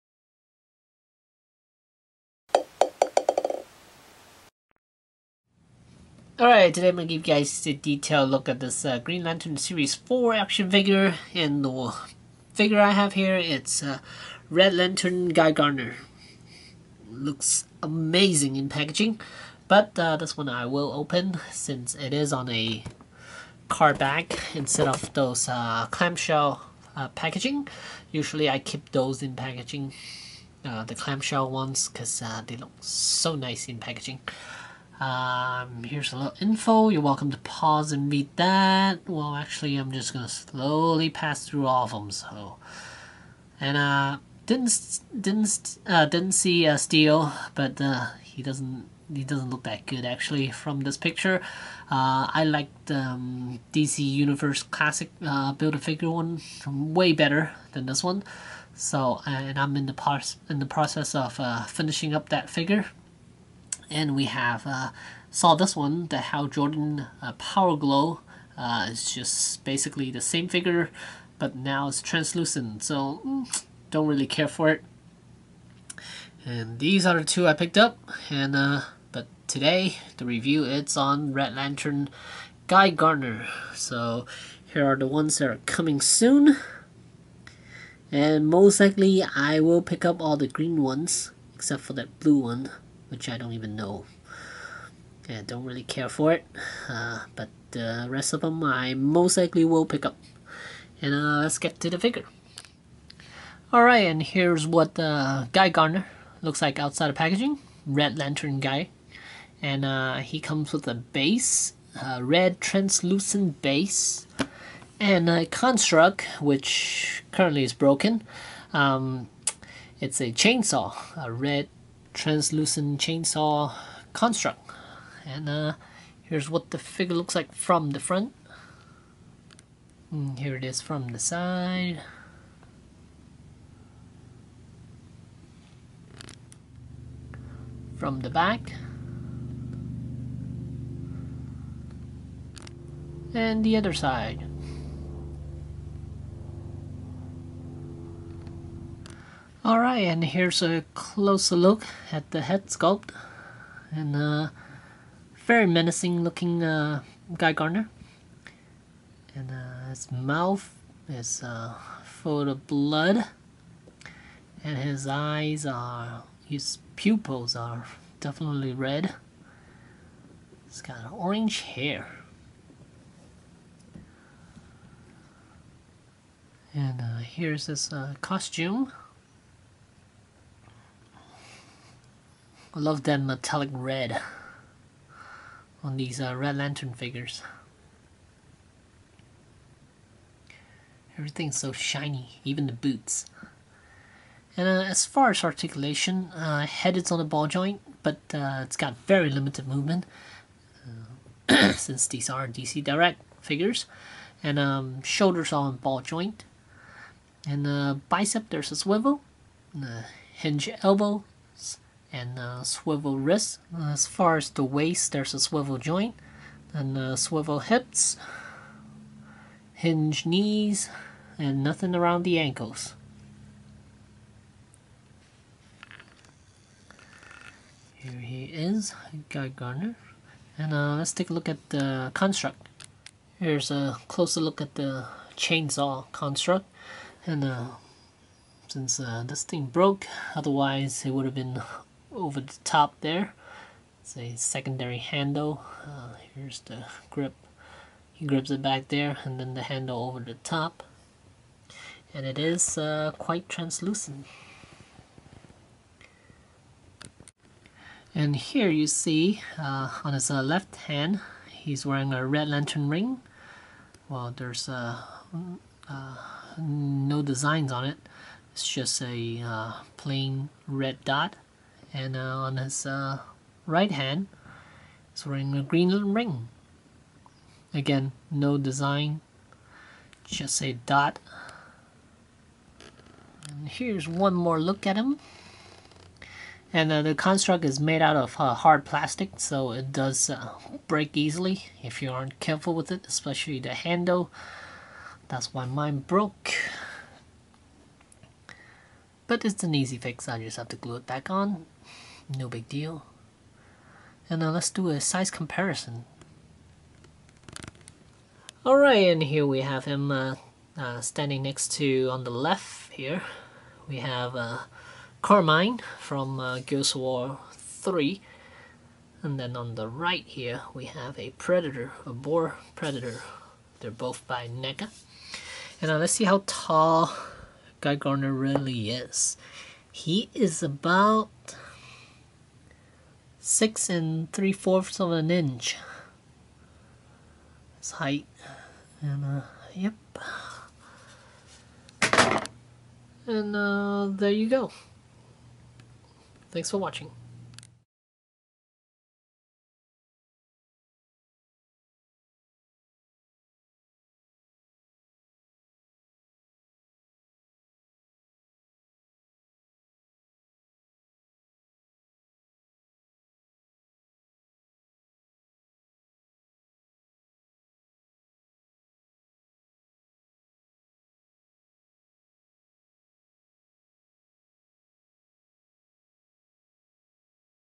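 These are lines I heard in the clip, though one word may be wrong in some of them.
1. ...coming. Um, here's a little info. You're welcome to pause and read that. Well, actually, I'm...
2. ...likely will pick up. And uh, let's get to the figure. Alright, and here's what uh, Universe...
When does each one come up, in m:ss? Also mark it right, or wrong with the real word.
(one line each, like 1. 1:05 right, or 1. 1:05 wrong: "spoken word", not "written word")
1. 0:33 wrong: "packaging", not "coming"
2. 1:39 wrong: "Guy", not "Universe".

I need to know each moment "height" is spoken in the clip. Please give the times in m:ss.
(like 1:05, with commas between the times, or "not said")
5:37.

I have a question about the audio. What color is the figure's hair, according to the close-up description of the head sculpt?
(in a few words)
orange.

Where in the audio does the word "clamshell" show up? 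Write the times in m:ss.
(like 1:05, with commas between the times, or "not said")
0:25, 0:30.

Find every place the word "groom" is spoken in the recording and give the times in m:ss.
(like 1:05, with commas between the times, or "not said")
not said.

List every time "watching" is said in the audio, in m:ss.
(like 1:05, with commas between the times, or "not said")
5:46.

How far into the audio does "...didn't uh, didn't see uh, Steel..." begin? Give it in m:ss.
0:45.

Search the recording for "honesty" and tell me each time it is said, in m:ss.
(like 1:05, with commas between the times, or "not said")
not said.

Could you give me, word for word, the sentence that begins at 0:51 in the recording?
Uh, I like the um, DC Universe classic uh, build a figure one way better than this one.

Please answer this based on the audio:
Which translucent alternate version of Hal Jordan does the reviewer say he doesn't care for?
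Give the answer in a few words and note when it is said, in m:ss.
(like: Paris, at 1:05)
Power Glow, at 1:07.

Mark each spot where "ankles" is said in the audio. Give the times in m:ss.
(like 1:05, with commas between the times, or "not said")
3:42.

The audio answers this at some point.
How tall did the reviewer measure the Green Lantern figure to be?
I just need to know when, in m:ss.
5:33.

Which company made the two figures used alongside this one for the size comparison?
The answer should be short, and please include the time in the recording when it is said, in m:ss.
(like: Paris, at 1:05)
NECA, at 5:24.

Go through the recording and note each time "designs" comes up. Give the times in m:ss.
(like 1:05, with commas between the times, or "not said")
4:27, 4:38.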